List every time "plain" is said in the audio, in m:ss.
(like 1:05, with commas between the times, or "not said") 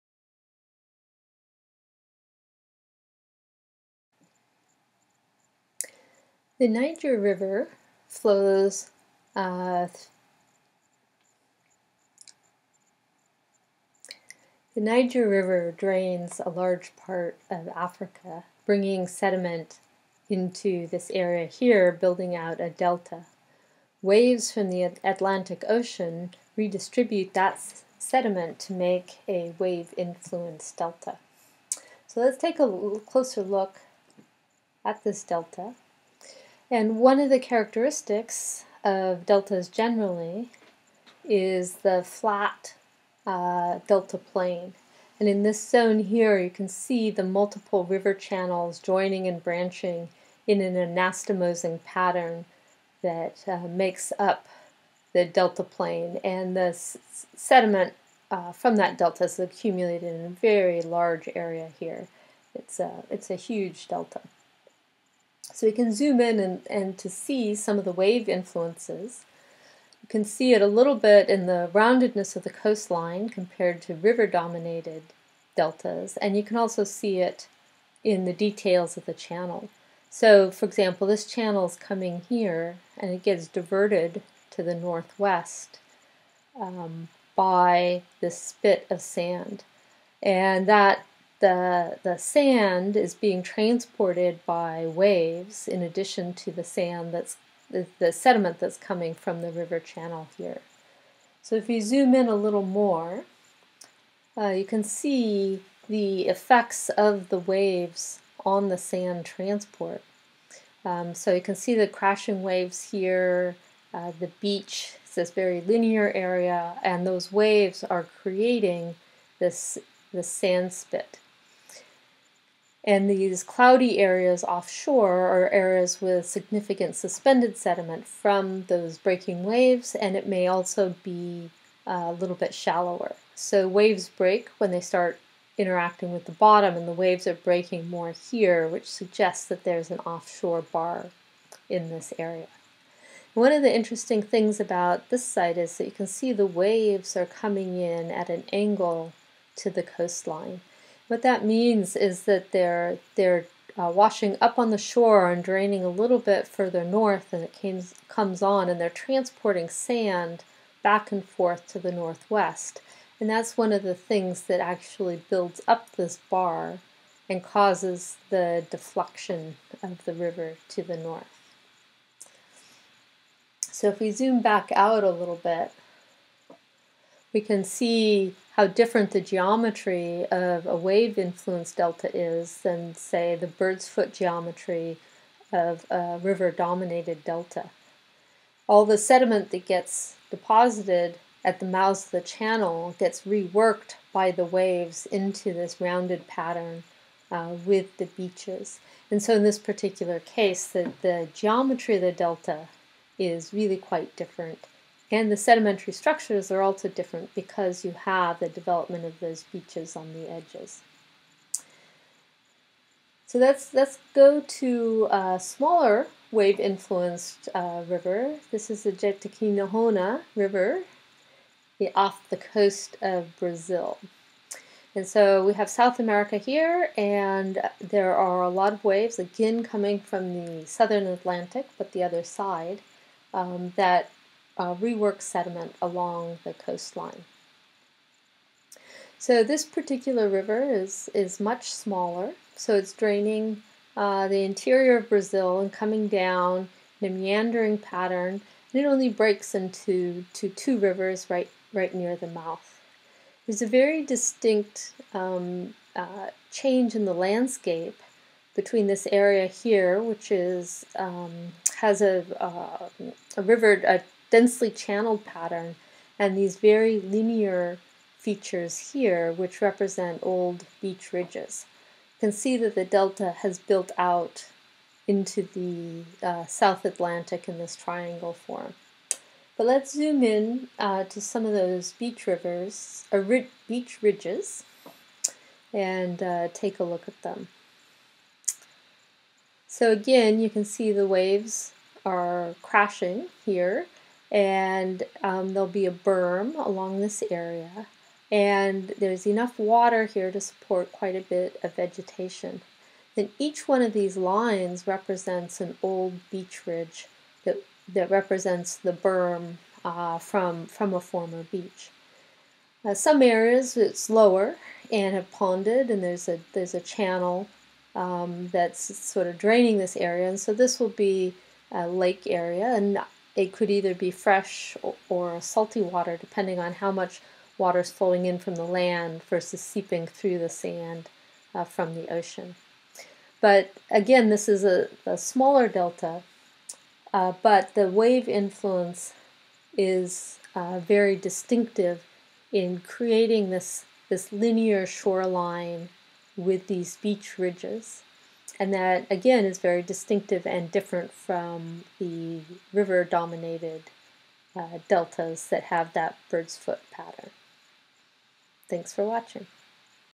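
0:44, 0:55.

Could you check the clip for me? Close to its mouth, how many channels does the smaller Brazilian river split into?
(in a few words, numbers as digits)
2.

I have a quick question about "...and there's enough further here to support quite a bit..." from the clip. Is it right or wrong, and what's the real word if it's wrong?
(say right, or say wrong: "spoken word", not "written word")
wrong: "water", not "further".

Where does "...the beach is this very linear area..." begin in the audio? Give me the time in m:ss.
1:54.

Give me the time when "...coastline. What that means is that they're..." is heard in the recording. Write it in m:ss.
2:29.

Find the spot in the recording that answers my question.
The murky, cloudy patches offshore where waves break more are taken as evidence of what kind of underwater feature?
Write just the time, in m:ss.
2:19.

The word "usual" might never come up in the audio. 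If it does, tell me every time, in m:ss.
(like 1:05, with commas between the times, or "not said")
not said.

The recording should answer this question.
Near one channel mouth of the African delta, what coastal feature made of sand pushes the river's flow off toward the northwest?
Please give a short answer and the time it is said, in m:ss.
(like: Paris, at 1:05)
spit of sand, at 1:28.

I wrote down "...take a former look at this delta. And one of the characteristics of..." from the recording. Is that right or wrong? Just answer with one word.
wrong.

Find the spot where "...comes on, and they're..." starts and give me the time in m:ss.
2:38.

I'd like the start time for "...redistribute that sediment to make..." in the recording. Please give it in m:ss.
0:26.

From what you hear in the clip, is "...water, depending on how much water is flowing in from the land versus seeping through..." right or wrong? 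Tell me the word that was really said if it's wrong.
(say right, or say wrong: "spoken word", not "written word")
right.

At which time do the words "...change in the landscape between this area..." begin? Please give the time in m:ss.
4:16.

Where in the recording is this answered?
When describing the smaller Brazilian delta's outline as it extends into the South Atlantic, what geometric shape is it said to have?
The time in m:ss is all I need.
4:37.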